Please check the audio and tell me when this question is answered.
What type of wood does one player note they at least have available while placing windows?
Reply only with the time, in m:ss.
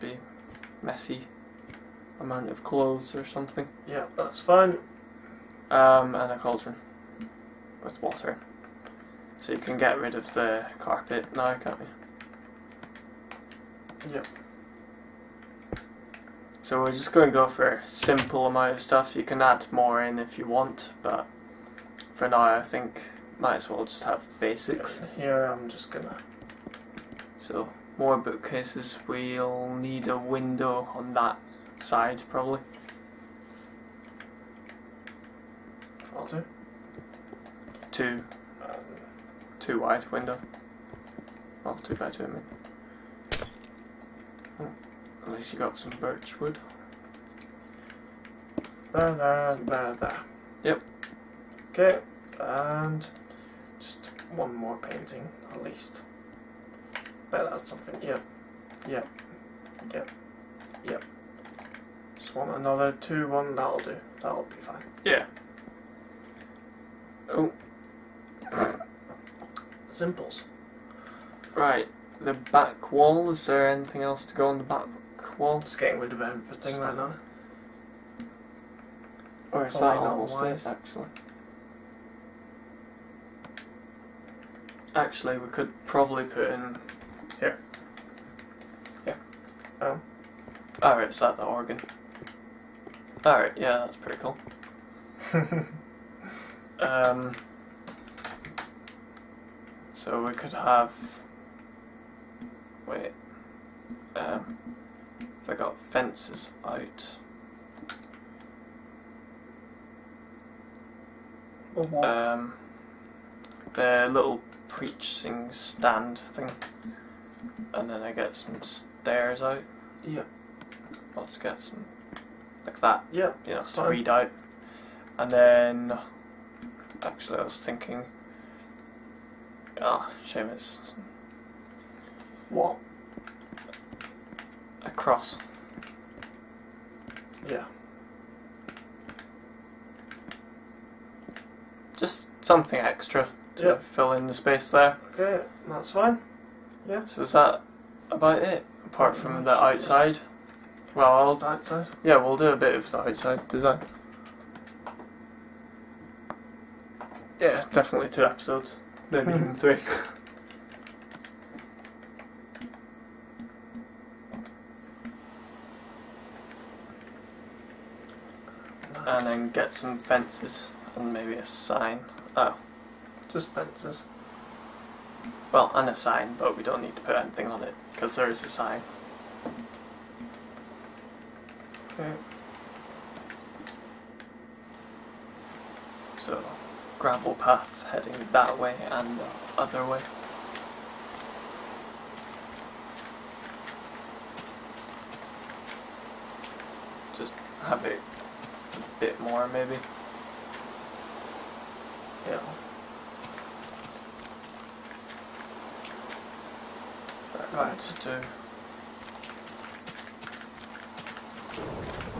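0:46.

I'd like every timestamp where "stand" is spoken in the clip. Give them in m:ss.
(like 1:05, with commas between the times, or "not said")
1:55.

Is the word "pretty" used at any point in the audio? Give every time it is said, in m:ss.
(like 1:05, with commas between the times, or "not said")
1:33.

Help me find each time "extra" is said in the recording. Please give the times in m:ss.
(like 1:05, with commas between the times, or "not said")
2:22.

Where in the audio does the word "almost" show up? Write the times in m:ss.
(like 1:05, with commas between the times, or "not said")
1:19.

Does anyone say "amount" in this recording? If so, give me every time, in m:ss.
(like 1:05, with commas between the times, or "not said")
0:02, 0:18.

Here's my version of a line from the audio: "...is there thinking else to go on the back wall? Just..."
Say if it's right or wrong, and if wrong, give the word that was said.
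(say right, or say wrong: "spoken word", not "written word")
wrong: "anything", not "thinking".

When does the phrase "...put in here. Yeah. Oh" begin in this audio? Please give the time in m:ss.
1:26.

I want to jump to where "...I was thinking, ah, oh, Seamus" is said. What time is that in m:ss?
2:07.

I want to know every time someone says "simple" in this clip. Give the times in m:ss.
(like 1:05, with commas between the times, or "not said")
0:17, 1:09.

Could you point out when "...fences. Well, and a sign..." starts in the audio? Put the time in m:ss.
2:53.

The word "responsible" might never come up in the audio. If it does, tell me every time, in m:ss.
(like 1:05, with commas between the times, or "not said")
not said.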